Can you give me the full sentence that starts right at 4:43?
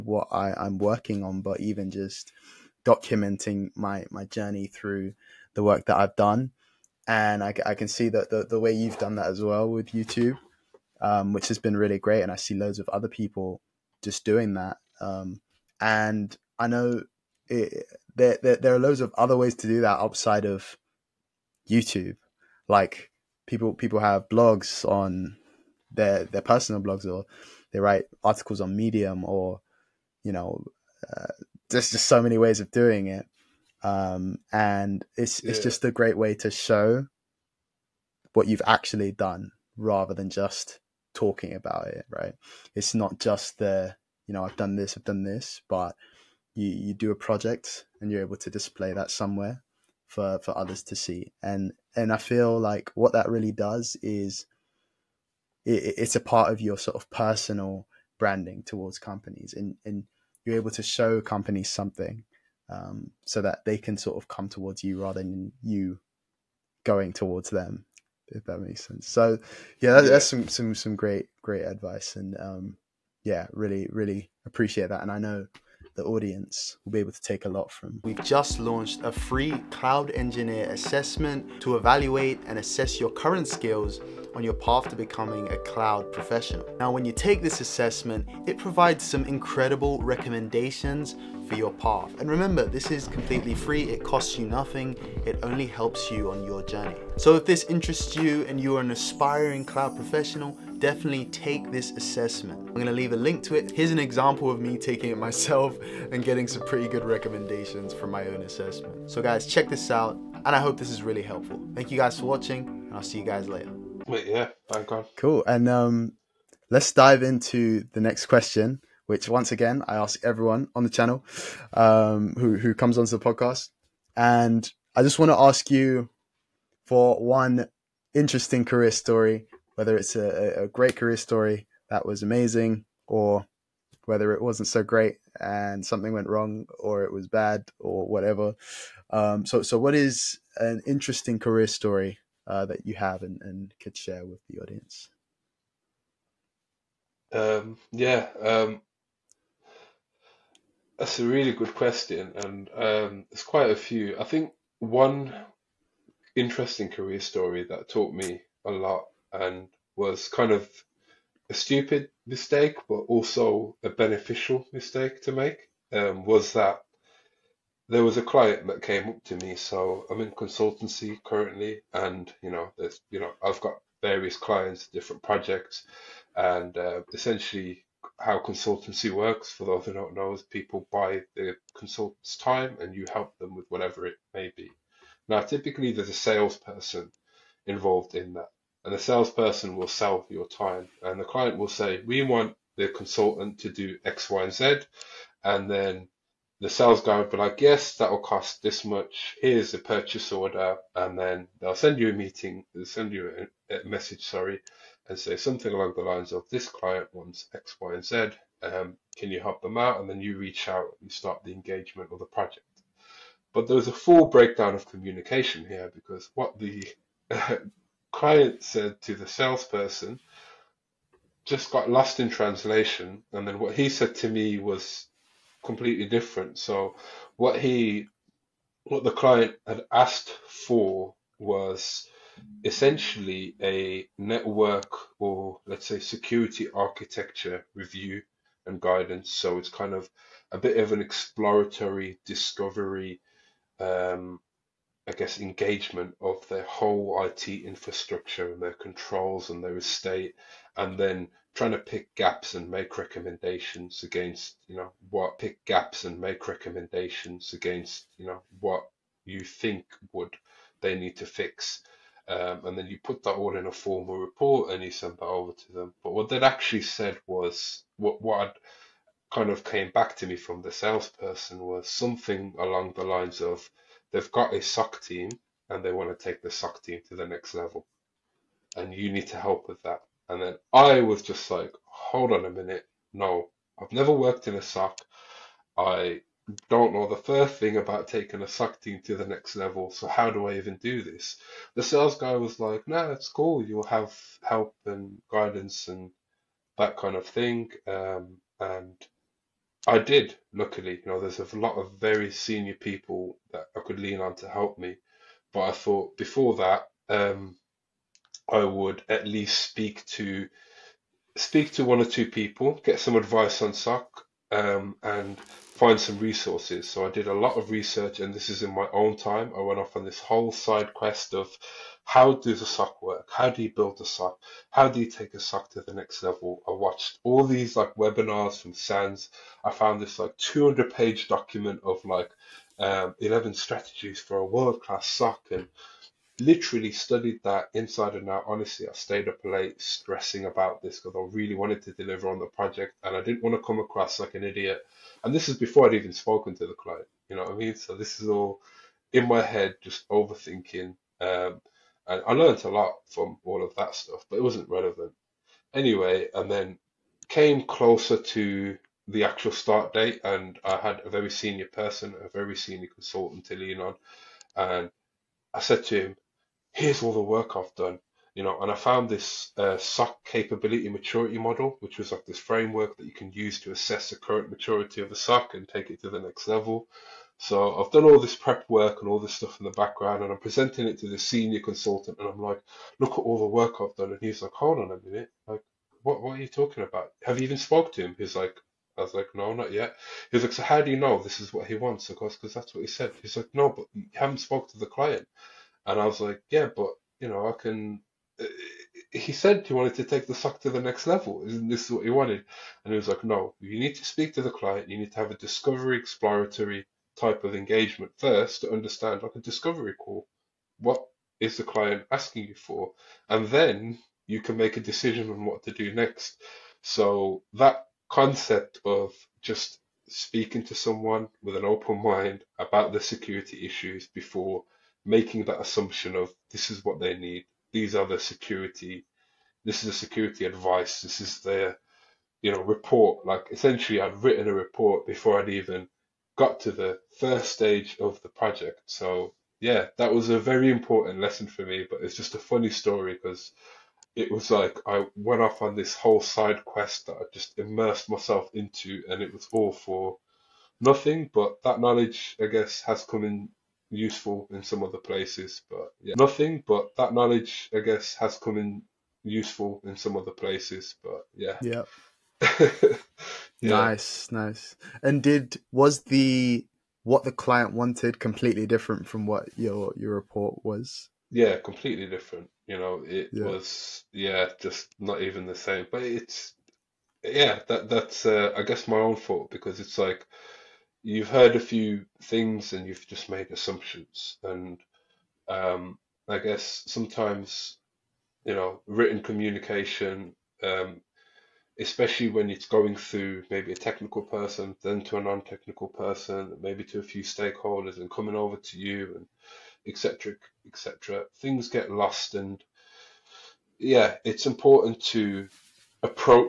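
No, I've never worked in a SOC.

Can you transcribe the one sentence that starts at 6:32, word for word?
Of course, because that's what he said.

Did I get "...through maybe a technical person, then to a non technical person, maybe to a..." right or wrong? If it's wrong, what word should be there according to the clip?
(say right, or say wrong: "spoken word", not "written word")
right.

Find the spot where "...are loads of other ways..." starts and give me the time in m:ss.
0:18.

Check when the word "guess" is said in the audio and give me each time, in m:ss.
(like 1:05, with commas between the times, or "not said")
4:05, 7:32, 7:37, 7:58, 8:06.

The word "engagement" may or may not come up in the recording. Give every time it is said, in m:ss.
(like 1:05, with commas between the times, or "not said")
3:31, 4:05, 6:47.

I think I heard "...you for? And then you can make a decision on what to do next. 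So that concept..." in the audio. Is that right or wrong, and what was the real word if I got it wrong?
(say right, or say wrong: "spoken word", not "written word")
right.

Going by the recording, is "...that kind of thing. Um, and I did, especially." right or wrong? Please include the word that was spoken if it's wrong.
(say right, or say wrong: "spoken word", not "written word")
wrong: "luckily", not "especially".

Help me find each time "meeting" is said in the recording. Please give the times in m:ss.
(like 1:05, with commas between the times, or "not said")
3:22.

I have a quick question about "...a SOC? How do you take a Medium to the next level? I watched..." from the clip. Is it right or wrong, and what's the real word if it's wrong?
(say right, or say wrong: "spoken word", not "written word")
wrong: "SOC", not "Medium".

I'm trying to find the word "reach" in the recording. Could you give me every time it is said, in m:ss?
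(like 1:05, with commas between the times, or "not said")
3:30.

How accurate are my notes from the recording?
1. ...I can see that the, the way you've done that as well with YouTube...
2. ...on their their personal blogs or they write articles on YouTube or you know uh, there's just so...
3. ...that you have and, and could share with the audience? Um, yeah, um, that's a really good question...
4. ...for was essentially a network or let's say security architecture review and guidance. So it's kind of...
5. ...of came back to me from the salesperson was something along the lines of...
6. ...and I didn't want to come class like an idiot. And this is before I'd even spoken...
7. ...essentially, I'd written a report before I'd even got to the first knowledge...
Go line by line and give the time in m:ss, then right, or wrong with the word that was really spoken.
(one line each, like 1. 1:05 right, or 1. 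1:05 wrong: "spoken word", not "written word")
1. 0:07 right
2. 0:24 wrong: "Medium", not "YouTube"
3. 2:22 right
4. 3:50 right
5. 4:29 right
6. 5:43 wrong: "across", not "class"
7. 7:13 wrong: "stage", not "knowledge".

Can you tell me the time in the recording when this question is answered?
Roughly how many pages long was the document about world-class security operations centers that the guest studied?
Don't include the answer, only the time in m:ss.
5:30.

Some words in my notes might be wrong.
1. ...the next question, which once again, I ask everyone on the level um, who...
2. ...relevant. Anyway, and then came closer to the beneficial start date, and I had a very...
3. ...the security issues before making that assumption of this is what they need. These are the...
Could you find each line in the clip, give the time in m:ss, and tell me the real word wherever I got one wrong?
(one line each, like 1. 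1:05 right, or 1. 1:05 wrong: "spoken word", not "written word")
1. 1:57 wrong: "channel", not "level"
2. 5:54 wrong: "actual", not "beneficial"
3. 7:02 right.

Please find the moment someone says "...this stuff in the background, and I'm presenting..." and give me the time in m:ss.
6:19.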